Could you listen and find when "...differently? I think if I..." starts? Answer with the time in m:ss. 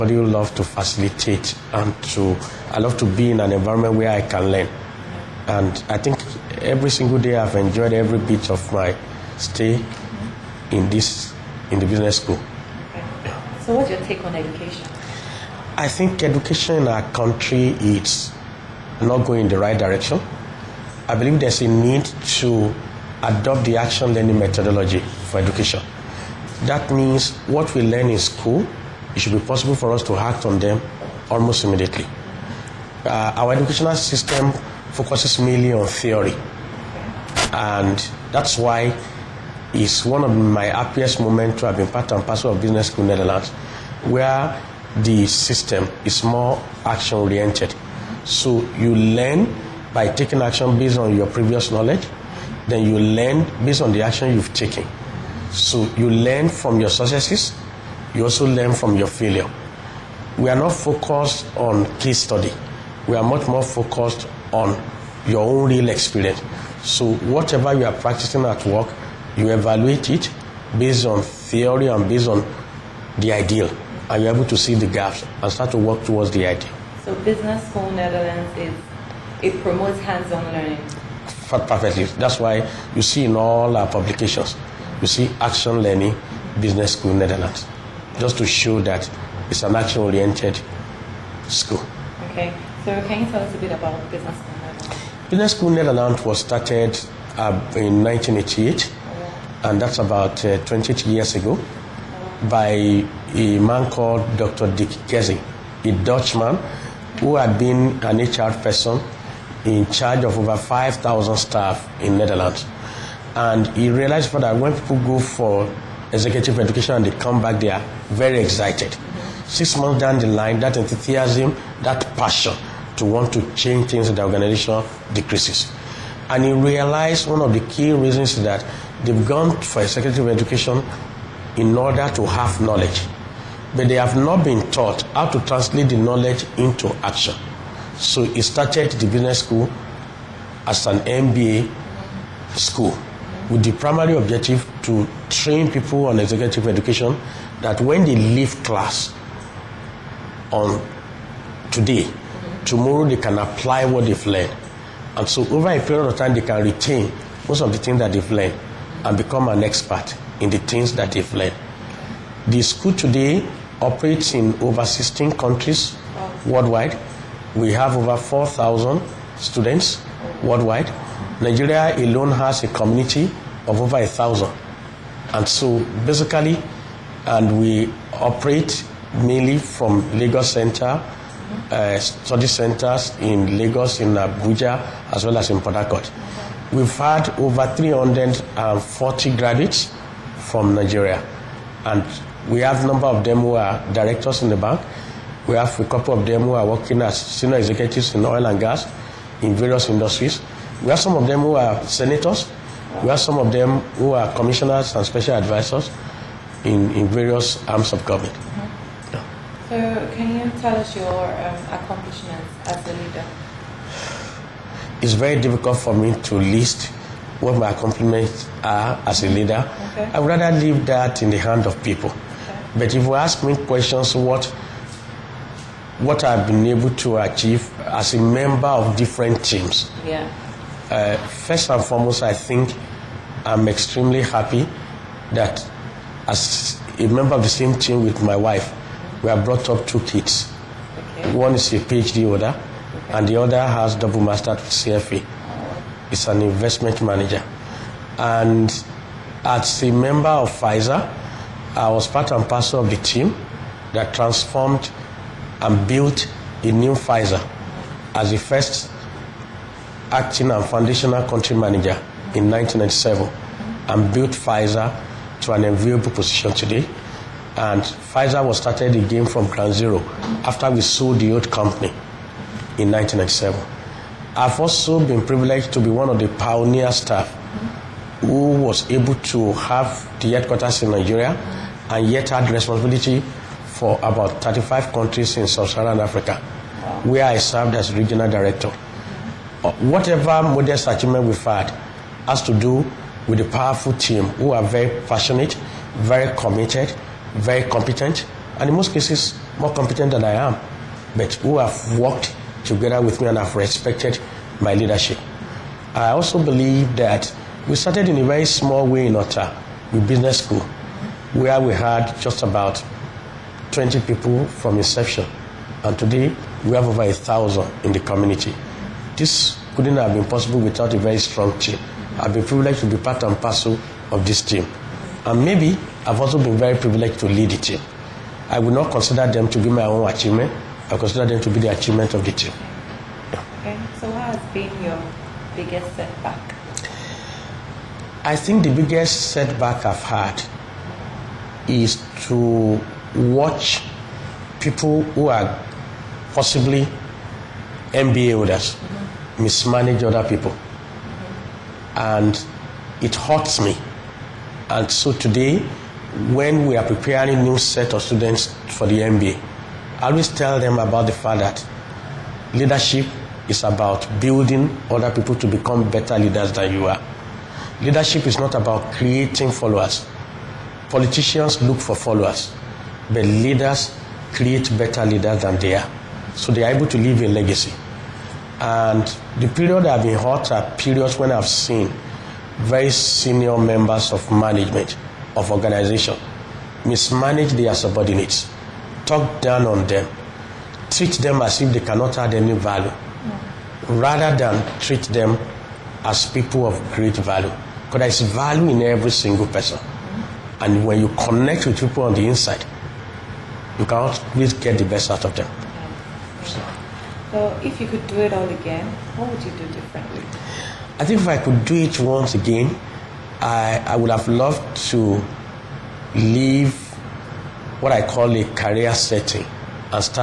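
6:49.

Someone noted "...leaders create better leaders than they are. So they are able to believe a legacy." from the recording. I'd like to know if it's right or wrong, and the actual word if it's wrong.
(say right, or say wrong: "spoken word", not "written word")
wrong: "leave", not "believe".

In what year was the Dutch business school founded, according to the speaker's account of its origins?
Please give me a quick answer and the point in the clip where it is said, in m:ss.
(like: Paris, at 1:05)
1988, at 1:38.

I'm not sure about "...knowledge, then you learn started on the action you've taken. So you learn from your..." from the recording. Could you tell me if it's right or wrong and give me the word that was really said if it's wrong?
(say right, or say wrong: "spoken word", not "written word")
wrong: "based", not "started".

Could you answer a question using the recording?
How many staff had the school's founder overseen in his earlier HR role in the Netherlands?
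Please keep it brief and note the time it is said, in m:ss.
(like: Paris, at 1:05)
5,000, at 1:50.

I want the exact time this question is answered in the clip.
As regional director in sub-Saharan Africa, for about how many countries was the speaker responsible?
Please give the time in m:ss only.
4:44.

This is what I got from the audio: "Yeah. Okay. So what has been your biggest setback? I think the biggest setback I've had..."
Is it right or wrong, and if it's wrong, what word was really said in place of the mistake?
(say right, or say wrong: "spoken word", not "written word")
right.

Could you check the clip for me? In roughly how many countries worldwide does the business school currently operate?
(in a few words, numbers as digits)
16.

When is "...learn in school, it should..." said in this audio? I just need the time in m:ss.
0:27.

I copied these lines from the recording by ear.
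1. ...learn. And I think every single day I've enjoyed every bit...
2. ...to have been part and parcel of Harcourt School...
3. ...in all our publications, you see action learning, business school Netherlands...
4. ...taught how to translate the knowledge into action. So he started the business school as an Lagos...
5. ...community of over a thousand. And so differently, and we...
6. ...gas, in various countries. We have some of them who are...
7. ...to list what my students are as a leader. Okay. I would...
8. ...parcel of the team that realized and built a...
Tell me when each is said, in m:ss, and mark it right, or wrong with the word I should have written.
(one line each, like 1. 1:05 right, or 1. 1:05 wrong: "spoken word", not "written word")
1. 0:04 right
2. 0:41 wrong: "Business", not "Harcourt"
3. 1:23 right
4. 2:14 wrong: "MBA", not "Lagos"
5. 2:52 wrong: "basically", not "differently"
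6. 3:18 wrong: "industries", not "countries"
7. 3:36 wrong: "accomplishments", not "students"
8. 4:12 wrong: "transformed", not "realized".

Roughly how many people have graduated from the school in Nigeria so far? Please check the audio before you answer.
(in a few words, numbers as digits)
340.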